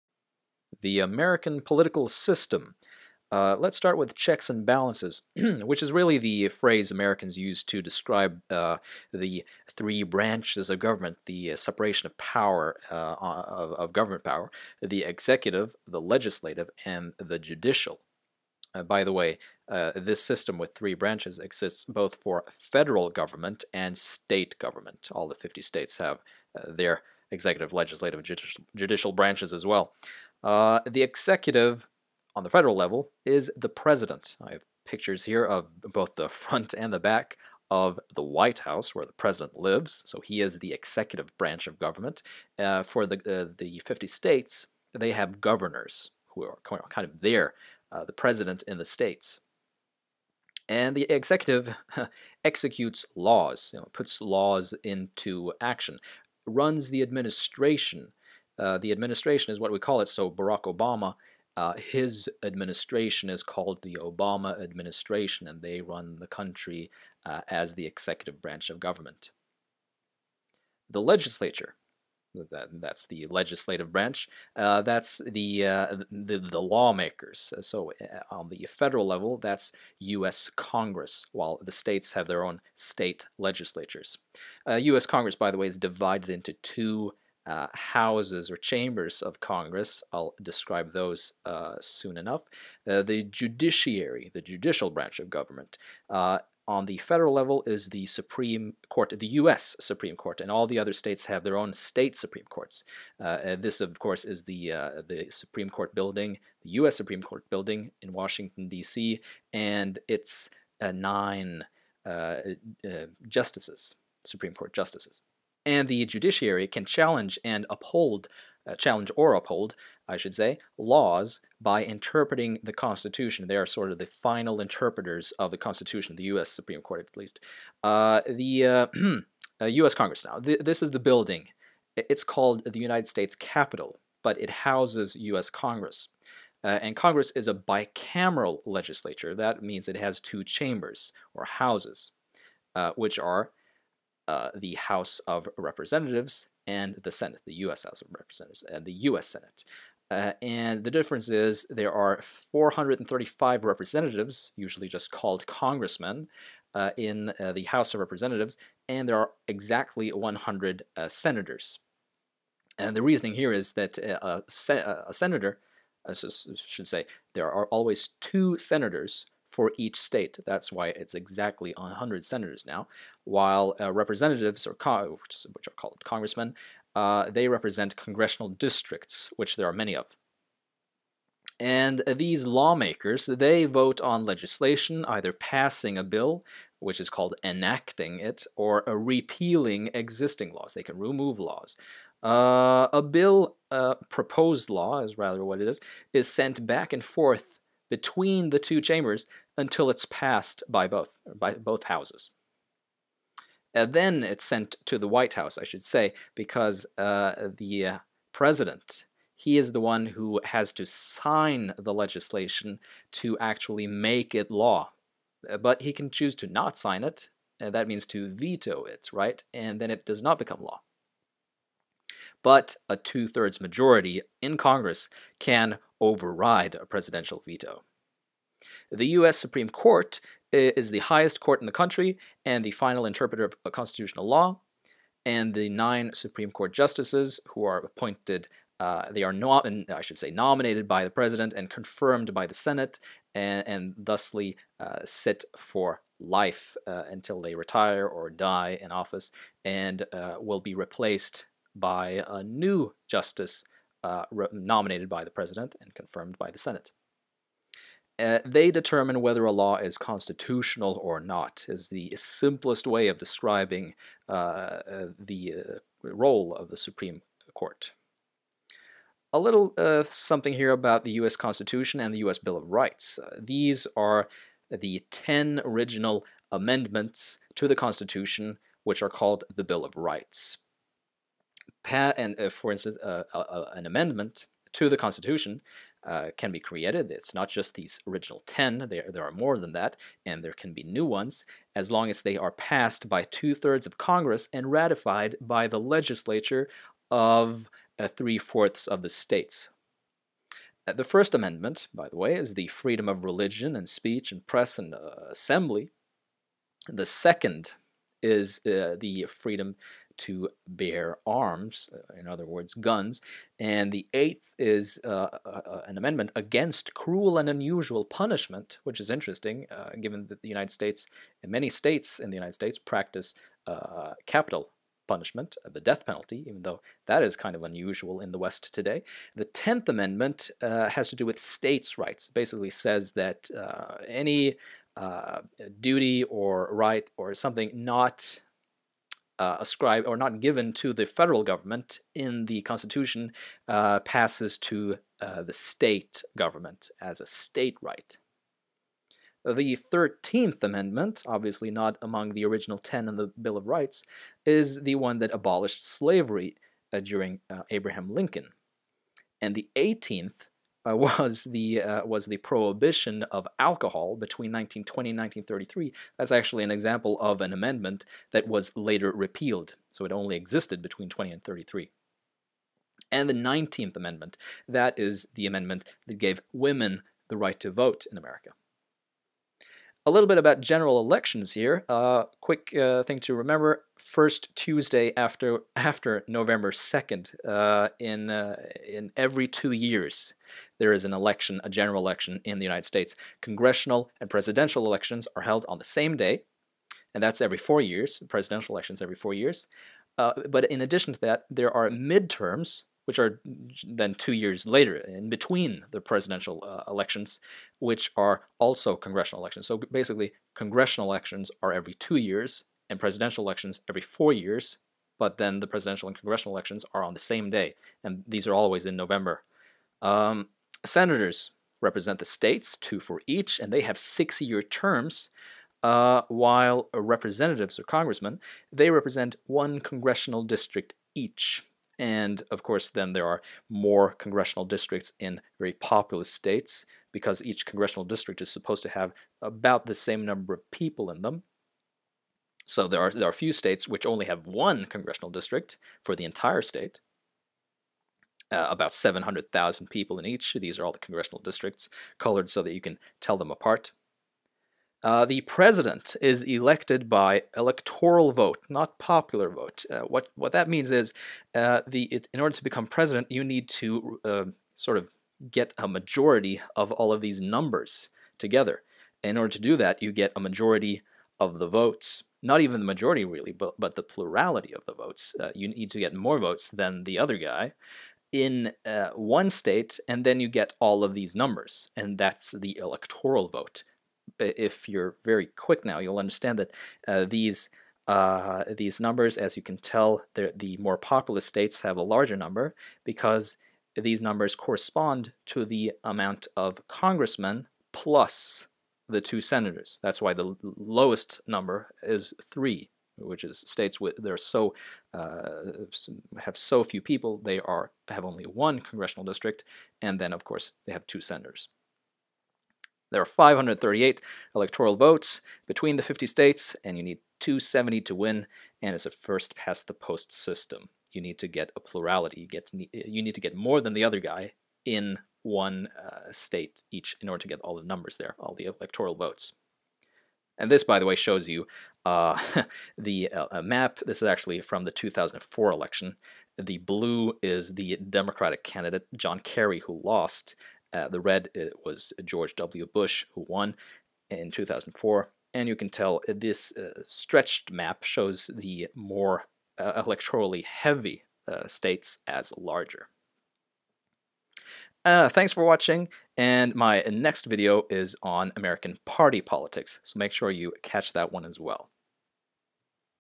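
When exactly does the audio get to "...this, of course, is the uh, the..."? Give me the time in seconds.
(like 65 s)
103 s.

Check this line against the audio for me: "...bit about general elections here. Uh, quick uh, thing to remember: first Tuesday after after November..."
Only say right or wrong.
right.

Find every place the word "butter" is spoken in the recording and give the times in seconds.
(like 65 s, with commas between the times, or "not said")
not said.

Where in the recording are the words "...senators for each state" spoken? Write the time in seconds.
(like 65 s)
168 s.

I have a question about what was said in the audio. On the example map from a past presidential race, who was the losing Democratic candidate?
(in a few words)
John Kerry.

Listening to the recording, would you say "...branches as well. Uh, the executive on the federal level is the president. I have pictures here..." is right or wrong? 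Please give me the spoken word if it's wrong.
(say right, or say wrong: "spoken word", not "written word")
right.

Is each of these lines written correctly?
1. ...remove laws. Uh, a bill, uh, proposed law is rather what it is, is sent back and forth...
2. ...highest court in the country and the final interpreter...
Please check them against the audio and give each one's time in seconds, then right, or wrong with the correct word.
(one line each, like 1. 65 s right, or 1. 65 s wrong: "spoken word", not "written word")
1. 190 s right
2. 230 s right.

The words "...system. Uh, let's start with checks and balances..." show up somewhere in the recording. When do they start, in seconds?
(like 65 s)
2 s.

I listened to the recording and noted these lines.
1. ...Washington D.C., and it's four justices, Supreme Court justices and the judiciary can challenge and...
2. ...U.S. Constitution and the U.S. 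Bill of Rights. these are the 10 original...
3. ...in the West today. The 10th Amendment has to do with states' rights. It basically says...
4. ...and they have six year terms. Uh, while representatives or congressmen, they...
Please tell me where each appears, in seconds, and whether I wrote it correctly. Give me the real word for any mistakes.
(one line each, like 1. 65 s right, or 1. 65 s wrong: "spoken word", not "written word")
1. 108 s wrong: "nine", not "four"
2. 271 s right
3. 328 s right
4. 423 s right.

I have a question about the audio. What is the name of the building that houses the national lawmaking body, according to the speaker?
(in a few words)
United States Capitol.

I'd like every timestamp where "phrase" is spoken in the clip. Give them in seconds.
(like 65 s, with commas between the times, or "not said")
6 s.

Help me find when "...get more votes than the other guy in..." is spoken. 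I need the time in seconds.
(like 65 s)
475 s.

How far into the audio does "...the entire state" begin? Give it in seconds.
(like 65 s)
446 s.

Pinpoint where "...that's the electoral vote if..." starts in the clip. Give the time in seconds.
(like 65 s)
482 s.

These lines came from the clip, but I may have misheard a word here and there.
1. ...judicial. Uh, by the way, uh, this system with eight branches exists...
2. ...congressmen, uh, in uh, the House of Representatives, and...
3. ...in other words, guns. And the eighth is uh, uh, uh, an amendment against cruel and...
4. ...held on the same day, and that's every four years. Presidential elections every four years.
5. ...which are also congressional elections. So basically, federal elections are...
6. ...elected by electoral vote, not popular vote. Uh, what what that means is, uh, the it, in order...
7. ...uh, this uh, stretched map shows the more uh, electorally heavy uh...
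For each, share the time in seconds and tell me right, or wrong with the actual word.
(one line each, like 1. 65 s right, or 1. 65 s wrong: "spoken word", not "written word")
1. 17 s wrong: "three", not "eight"
2. 155 s right
3. 312 s right
4. 395 s right
5. 407 s wrong: "congressional", not "federal"
6. 456 s right
7. 546 s right.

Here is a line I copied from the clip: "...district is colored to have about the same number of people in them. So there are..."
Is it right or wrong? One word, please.
wrong.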